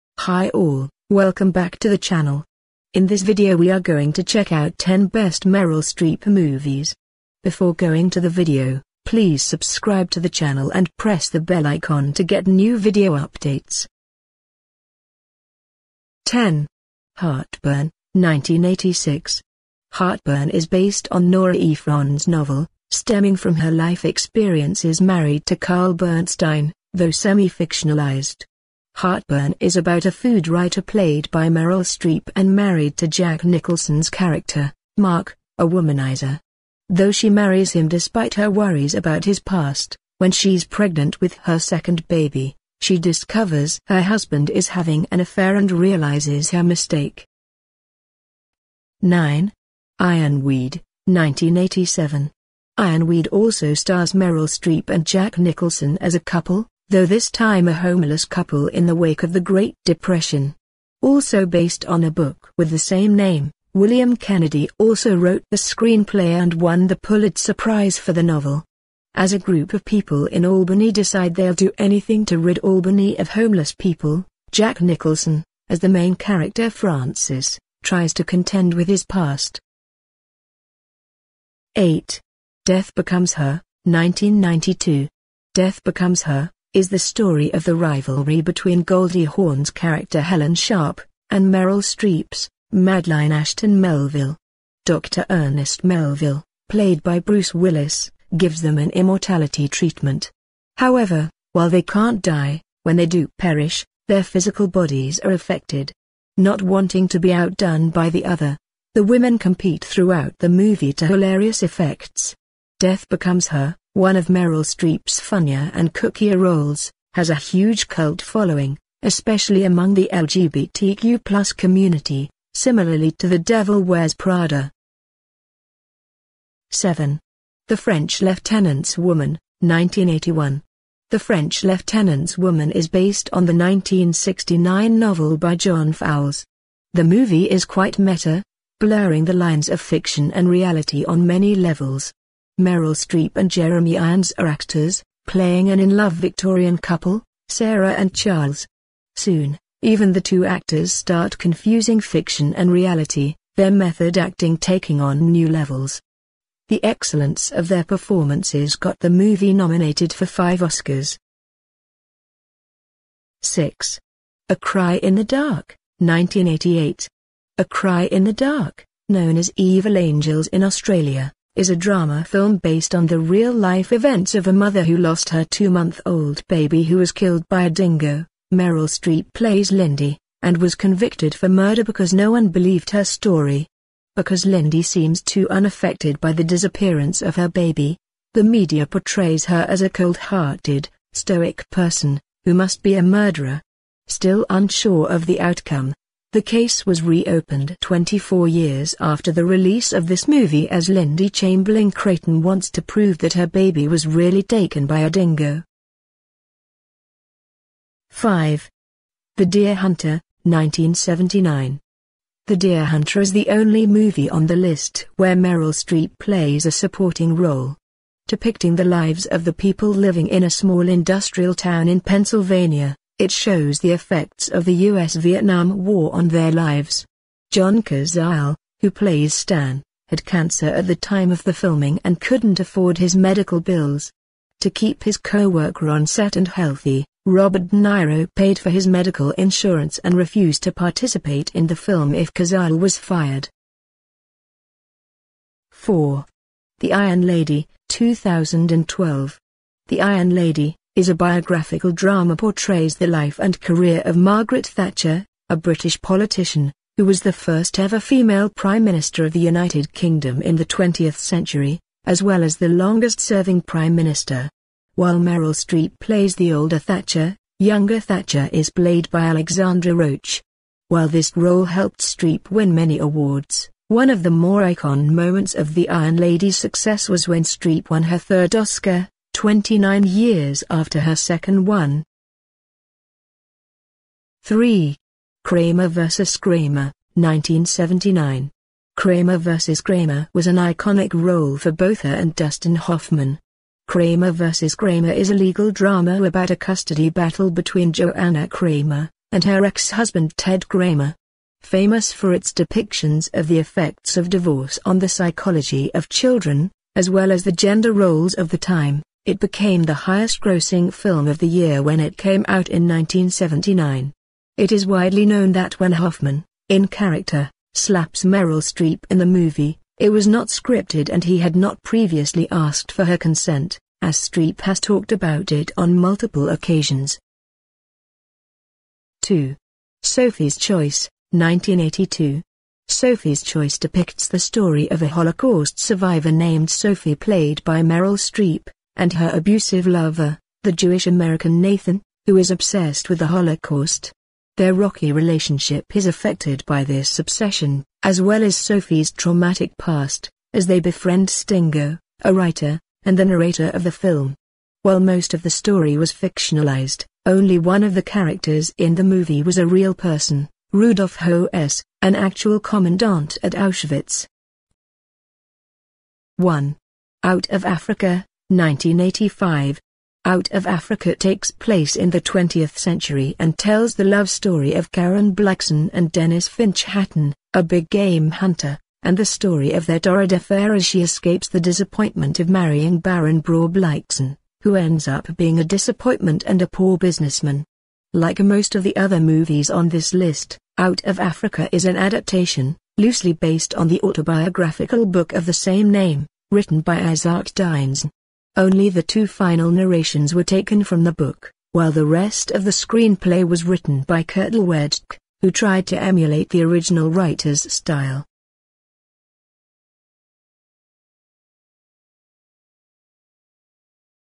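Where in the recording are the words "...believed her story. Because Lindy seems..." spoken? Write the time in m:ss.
3:02.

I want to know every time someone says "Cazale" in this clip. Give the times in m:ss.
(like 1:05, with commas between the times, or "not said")
3:47, 4:02.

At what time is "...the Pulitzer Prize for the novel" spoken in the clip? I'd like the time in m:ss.
1:06.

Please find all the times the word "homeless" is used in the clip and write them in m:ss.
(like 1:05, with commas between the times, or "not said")
0:57, 1:13.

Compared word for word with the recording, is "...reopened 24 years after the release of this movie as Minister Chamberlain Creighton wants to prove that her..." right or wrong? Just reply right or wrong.
wrong.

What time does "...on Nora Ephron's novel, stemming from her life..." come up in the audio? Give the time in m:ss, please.
0:21.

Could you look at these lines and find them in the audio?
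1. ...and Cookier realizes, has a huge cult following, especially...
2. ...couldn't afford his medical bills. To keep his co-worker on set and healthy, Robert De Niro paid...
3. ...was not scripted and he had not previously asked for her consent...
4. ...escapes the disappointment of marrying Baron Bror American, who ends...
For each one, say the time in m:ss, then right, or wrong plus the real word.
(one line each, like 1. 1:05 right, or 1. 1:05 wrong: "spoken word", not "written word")
1. 1:55 wrong: "roles", not "realizes"
2. 3:52 right
3. 5:20 right
4. 6:21 wrong: "Blixen", not "American".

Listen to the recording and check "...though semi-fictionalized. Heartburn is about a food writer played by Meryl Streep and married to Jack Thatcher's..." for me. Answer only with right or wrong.
wrong.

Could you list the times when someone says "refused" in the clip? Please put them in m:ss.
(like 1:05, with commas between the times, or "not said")
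4:00.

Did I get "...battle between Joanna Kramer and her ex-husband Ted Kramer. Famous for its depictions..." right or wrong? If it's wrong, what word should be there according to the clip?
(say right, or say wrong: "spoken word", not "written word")
right.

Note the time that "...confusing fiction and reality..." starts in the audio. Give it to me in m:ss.
2:31.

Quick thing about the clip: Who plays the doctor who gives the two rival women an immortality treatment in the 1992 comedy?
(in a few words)
Bruce Willis.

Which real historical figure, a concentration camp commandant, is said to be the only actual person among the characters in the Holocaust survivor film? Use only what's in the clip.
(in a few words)
Rudolf Hoess.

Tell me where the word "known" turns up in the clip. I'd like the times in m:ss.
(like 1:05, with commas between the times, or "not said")
2:49, 5:15.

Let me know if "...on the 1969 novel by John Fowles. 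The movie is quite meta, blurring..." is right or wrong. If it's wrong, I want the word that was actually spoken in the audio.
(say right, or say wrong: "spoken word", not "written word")
right.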